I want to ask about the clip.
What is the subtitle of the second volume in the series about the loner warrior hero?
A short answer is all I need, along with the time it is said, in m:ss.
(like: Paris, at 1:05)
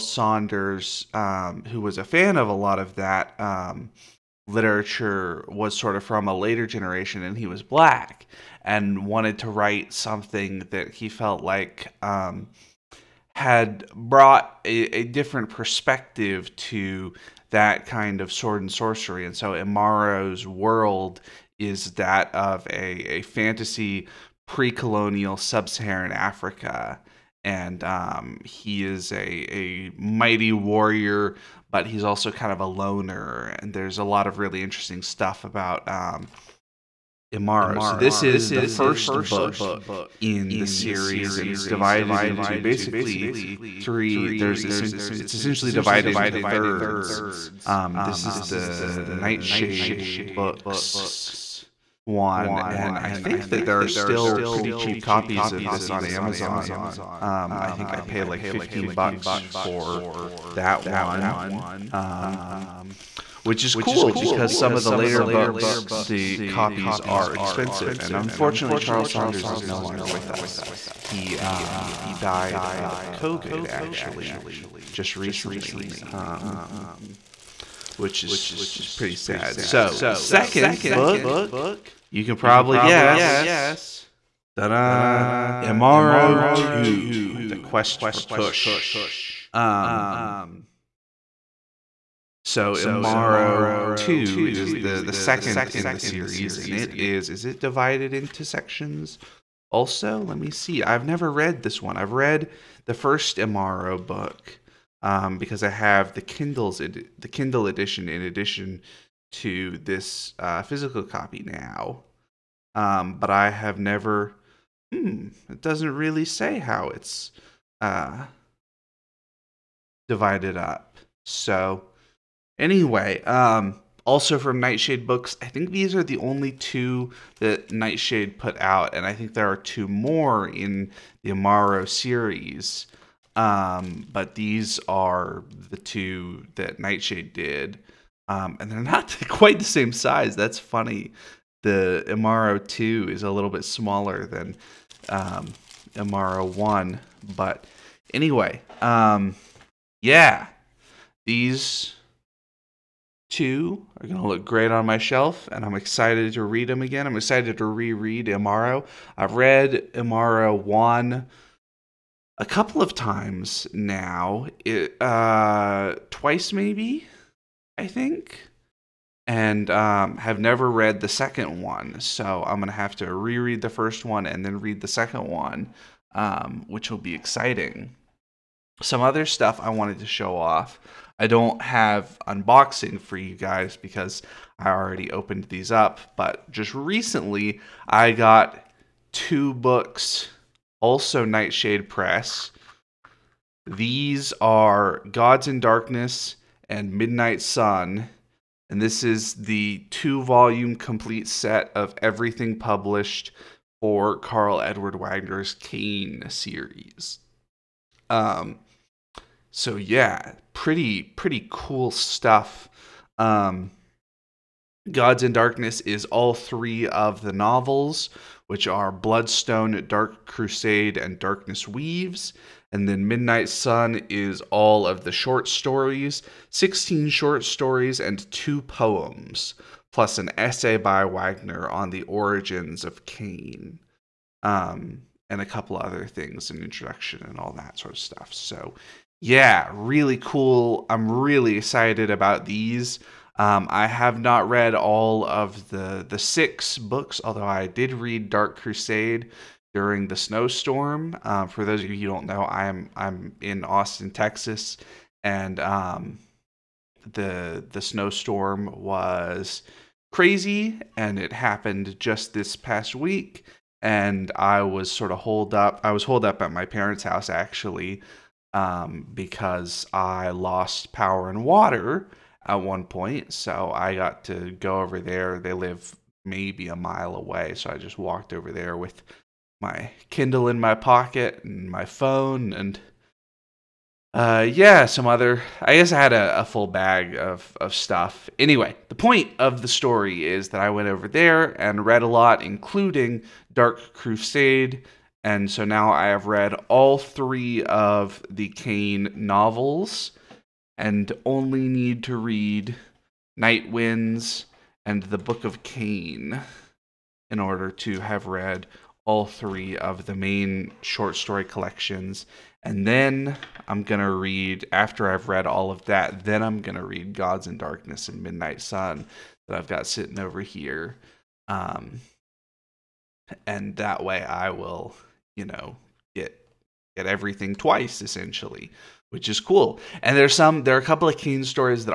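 The Quest for Kush, at 1:27.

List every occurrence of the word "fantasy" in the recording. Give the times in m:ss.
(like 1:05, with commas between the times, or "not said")
0:23.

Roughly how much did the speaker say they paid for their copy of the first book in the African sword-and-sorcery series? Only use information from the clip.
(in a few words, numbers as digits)
$15.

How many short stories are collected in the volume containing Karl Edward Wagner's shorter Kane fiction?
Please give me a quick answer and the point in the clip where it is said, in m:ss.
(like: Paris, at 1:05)
16, at 3:46.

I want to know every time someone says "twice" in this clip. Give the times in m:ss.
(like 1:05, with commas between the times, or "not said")
2:46, 5:27.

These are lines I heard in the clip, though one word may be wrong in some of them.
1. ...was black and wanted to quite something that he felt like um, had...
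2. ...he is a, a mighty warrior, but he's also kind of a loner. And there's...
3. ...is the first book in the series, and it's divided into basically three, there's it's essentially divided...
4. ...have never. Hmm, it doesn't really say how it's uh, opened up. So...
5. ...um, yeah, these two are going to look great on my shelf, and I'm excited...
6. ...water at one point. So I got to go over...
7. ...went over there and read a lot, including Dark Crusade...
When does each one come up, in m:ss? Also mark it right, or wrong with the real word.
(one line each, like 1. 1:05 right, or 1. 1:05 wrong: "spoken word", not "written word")
1. 0:07 wrong: "write", not "quite"
2. 0:28 right
3. 0:38 right
4. 1:53 wrong: "divided", not "opened"
5. 2:28 right
6. 4:31 right
7. 4:50 right.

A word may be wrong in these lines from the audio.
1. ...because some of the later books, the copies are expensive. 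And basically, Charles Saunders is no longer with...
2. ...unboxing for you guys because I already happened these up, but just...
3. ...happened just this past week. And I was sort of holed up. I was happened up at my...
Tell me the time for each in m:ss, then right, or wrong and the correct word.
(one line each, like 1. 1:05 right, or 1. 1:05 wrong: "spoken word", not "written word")
1. 1:04 wrong: "unfortunately", not "basically"
2. 3:02 wrong: "opened", not "happened"
3. 4:21 wrong: "holed", not "happened".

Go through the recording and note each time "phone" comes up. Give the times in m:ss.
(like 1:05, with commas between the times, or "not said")
4:41.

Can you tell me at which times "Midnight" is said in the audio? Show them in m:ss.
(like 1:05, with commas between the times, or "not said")
3:16, 3:43, 5:18.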